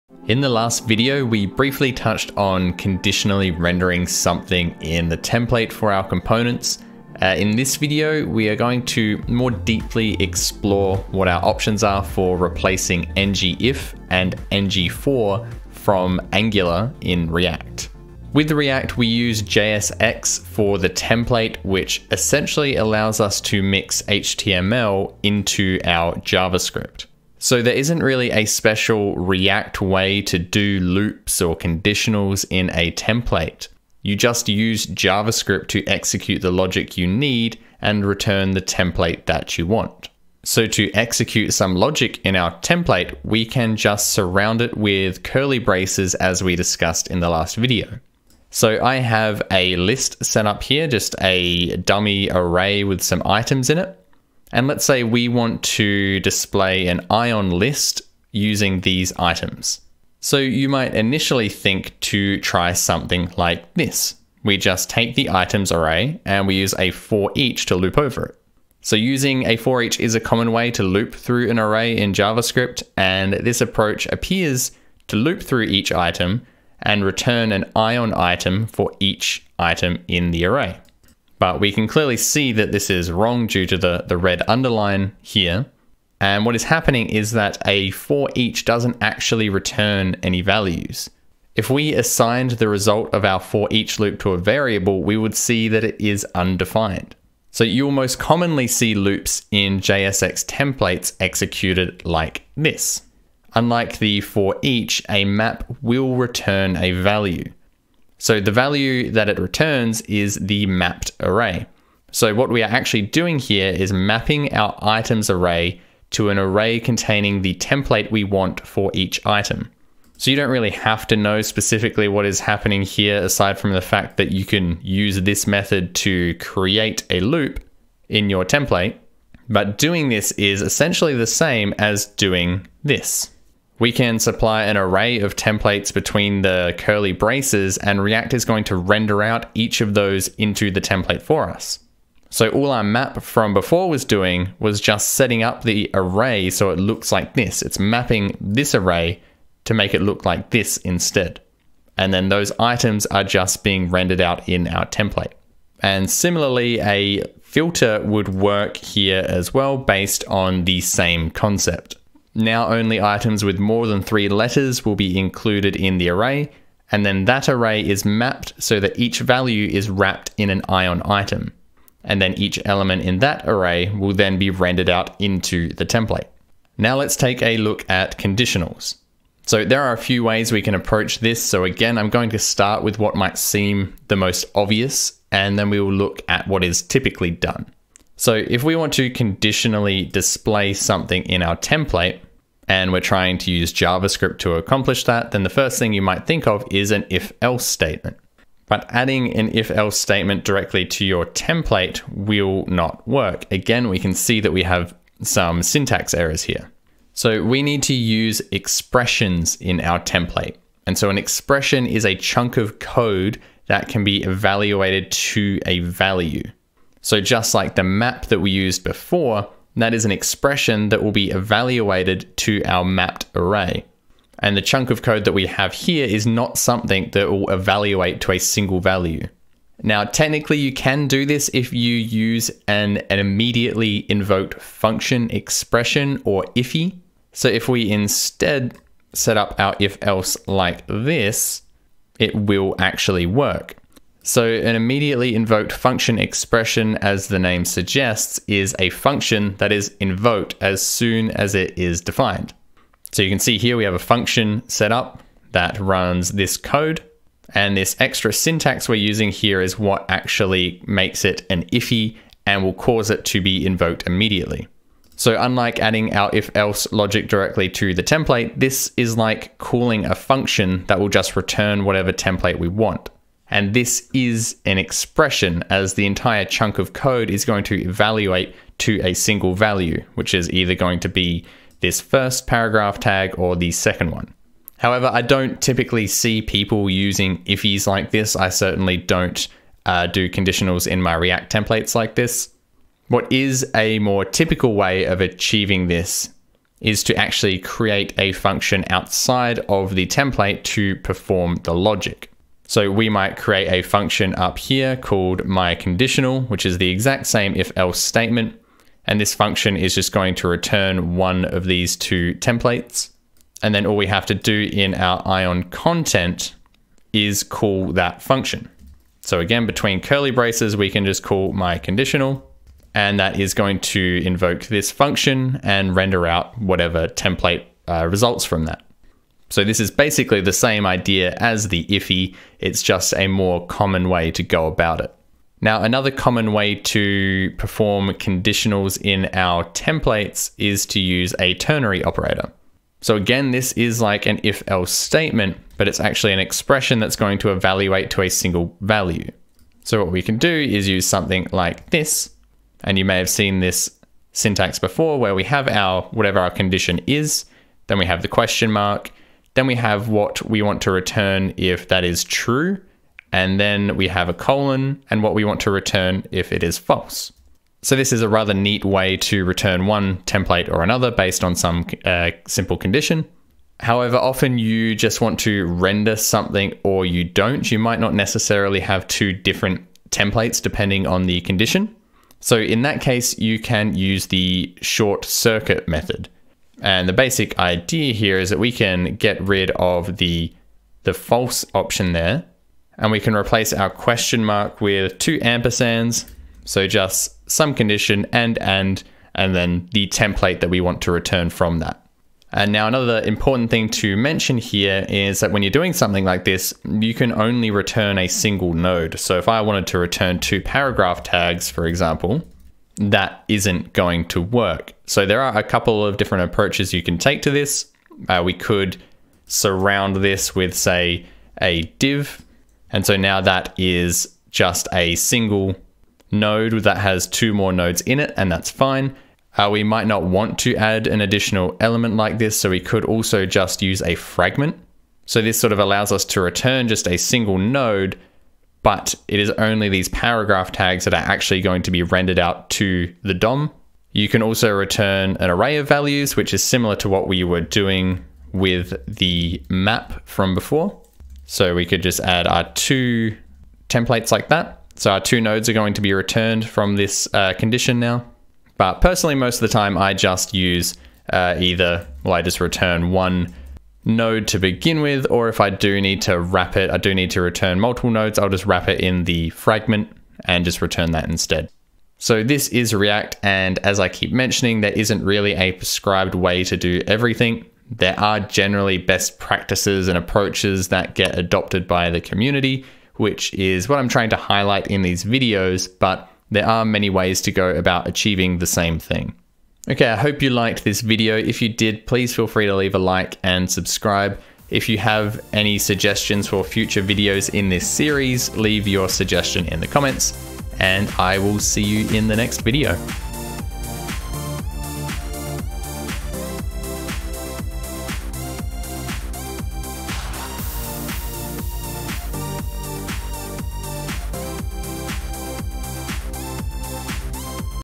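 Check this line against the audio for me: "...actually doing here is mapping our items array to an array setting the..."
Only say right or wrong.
wrong.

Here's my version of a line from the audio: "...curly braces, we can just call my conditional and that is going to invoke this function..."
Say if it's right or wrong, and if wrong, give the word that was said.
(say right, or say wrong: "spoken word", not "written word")
right.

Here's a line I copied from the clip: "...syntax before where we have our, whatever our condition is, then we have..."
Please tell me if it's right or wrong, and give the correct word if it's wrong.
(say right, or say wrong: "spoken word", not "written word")
right.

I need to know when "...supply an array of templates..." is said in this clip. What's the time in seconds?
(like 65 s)
134 s.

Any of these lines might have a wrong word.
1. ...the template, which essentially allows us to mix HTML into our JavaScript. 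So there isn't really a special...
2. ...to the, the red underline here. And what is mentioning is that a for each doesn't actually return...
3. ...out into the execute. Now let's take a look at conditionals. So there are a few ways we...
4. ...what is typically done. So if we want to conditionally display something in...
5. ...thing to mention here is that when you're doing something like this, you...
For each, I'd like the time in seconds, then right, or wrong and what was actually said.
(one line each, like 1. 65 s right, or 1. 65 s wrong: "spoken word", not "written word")
1. 20 s right
2. 83 s wrong: "happening", not "mentioning"
3. 174 s wrong: "template", not "execute"
4. 186 s right
5. 403 s right.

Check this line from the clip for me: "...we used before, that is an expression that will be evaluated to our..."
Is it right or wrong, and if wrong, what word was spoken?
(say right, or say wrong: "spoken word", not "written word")
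right.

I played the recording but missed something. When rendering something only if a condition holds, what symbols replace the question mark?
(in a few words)
two ampersands.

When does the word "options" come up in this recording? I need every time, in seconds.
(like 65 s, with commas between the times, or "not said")
11 s, 391 s.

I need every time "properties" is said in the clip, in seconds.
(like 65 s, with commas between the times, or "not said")
not said.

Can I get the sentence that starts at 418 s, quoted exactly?
Uh, we could surround this with say a div.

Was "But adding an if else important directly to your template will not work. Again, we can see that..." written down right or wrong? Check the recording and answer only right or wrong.
wrong.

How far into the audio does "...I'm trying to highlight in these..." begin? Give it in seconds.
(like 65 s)
483 s.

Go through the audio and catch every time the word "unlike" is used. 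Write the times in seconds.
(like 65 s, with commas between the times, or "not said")
103 s, 265 s.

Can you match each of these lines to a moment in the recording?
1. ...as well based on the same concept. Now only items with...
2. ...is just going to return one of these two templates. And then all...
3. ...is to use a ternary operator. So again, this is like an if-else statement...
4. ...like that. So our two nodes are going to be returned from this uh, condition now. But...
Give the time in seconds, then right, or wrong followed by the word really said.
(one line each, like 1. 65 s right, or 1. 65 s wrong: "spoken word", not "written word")
1. 159 s right
2. 309 s right
3. 340 s right
4. 454 s right.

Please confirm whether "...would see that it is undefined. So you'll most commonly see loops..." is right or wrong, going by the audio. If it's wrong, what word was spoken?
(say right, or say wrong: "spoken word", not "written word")
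right.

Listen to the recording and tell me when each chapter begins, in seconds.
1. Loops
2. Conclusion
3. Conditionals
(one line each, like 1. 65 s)
1. 48 s
2. 472 s
3. 176 s.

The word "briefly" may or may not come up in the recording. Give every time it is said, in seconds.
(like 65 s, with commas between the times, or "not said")
1 s.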